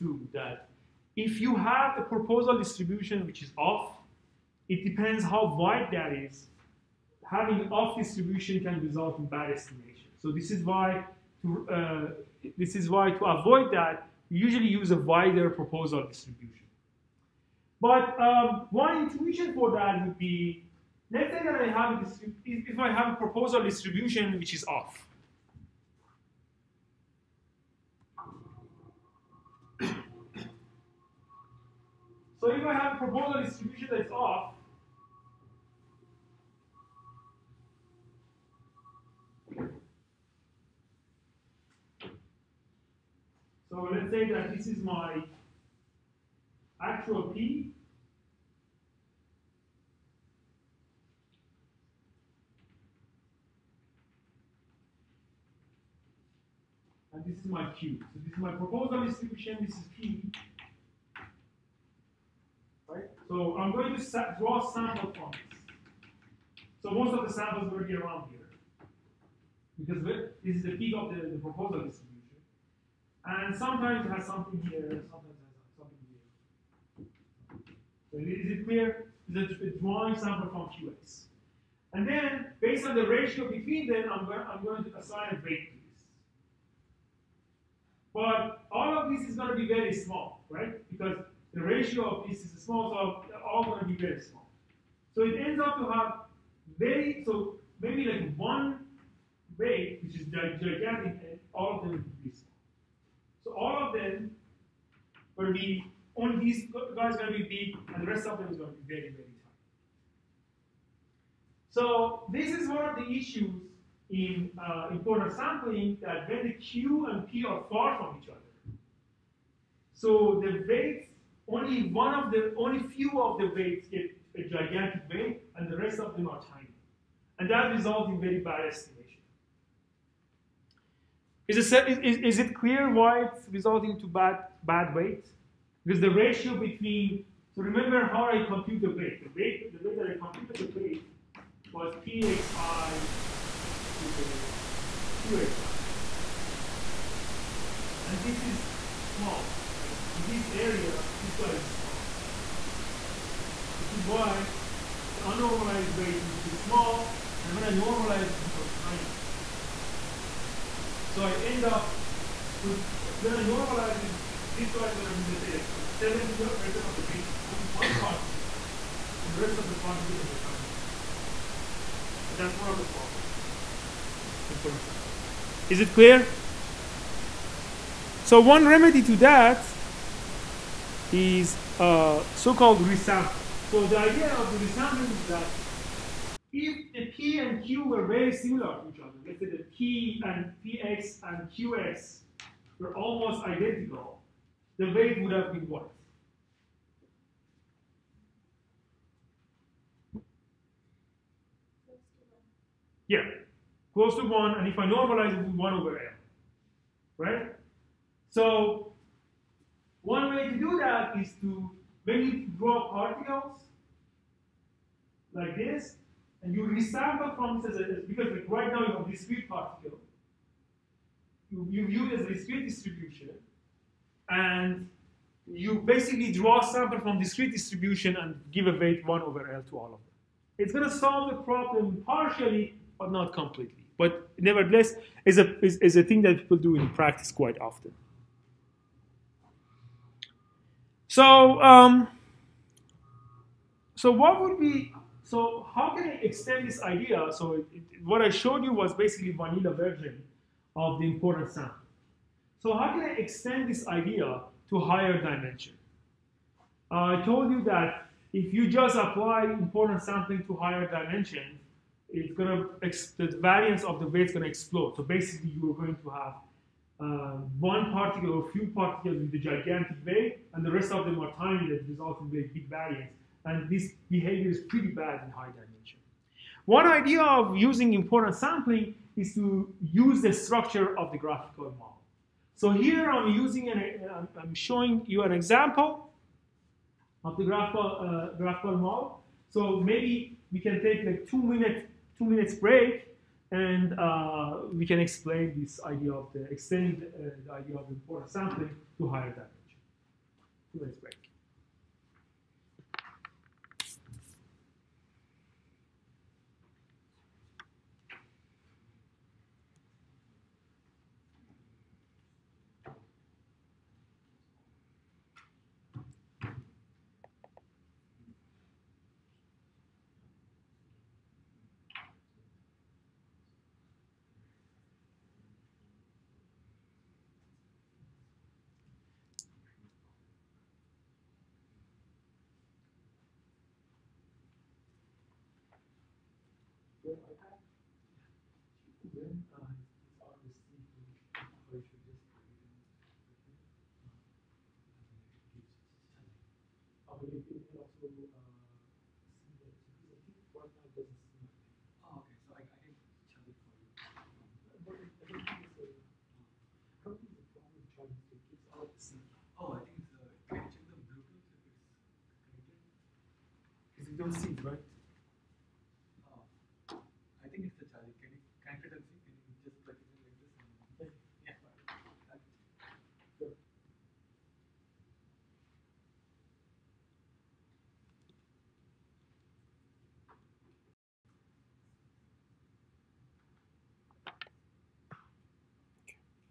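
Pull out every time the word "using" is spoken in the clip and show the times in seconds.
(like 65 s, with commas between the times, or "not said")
277 s, 283 s.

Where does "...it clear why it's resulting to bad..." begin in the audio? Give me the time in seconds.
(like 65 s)
132 s.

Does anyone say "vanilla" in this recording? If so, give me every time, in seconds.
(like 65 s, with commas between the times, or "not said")
249 s.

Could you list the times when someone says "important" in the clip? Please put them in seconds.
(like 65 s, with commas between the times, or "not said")
114 s, 174 s, 251 s, 259 s, 277 s, 297 s.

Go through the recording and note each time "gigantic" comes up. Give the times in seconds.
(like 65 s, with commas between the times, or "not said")
100 s, 124 s, 269 s.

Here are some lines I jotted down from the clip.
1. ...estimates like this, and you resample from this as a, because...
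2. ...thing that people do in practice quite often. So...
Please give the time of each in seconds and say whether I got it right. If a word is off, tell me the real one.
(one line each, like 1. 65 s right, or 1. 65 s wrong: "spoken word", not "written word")
1. 212 s wrong: "particles", not "estimates"
2. 236 s right.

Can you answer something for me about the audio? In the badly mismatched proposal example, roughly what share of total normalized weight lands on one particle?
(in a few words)
70%.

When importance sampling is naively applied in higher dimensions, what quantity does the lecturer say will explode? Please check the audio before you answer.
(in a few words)
The variance of the weight.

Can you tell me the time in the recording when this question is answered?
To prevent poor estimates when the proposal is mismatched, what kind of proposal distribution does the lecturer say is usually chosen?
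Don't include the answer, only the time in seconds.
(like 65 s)
14 s.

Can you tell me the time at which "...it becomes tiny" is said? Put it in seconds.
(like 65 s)
158 s.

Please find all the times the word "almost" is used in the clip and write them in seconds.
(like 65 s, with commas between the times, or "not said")
192 s.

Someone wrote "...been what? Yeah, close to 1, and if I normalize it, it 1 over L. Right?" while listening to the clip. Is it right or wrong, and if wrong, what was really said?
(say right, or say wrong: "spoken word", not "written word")
right.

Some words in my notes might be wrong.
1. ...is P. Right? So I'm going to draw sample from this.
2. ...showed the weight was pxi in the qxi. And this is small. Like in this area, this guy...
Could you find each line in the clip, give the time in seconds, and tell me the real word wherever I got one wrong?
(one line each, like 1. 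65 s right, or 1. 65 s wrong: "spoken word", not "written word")
1. 59 s right
2. 140 s wrong: "computed", not "showed".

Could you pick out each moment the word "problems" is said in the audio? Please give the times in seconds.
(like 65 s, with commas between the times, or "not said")
172 s, 231 s.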